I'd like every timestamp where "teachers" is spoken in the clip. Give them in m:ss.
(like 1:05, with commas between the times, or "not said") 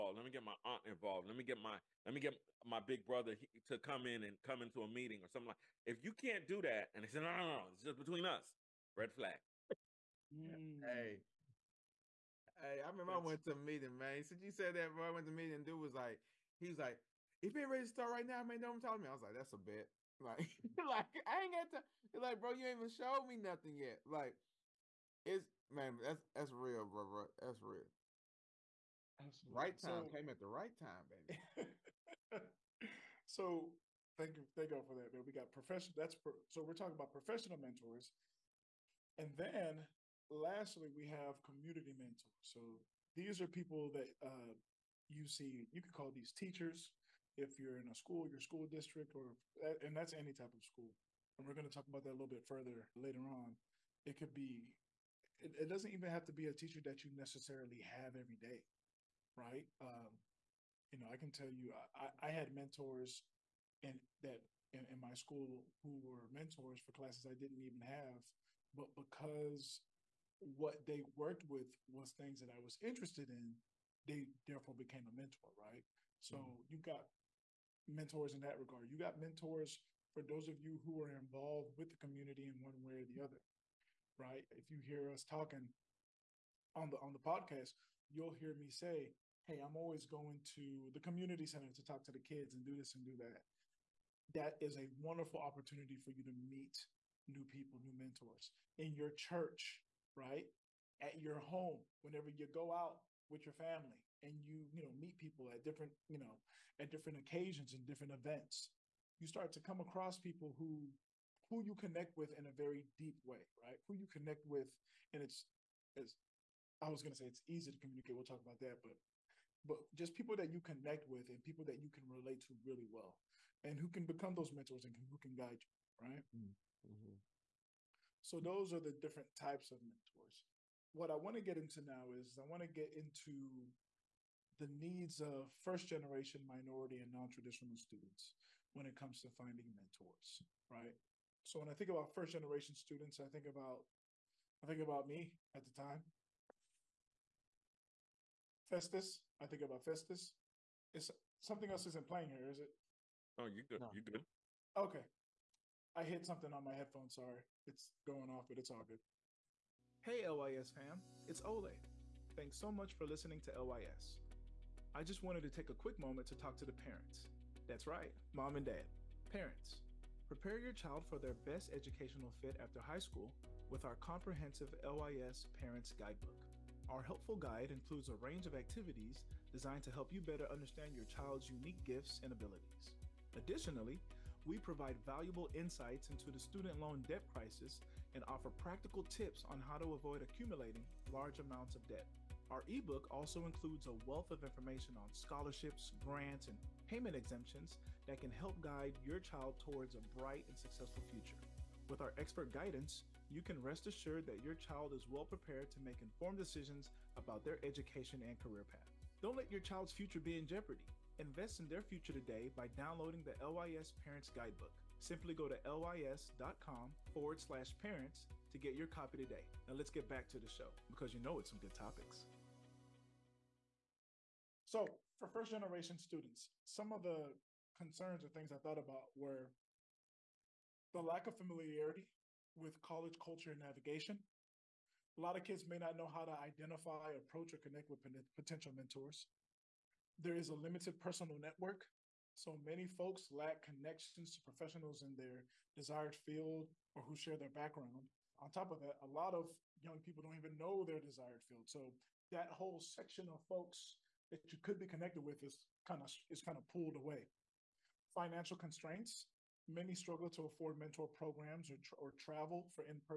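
0:46, 0:56.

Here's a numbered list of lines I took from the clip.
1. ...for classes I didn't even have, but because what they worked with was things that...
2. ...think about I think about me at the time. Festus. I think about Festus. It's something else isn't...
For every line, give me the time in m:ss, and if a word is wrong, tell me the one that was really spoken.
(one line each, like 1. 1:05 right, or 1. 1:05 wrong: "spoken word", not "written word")
1. 1:06 right
2. 2:23 right.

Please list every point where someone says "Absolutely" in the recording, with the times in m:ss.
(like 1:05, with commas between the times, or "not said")
0:29.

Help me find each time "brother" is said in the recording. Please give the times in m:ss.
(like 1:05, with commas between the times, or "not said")
0:03.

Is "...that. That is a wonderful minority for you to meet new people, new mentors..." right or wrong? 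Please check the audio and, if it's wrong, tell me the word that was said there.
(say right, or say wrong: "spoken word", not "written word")
wrong: "opportunity", not "minority".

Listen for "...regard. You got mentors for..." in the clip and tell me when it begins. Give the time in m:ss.
1:18.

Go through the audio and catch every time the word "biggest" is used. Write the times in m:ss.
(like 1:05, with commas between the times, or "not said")
not said.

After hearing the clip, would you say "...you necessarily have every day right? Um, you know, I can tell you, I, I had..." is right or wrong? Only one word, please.
right.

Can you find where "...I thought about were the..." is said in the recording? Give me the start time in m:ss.
3:48.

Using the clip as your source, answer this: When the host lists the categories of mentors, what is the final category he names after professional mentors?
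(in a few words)
community mentors.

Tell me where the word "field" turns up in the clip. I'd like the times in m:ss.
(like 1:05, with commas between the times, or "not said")
4:06, 4:11.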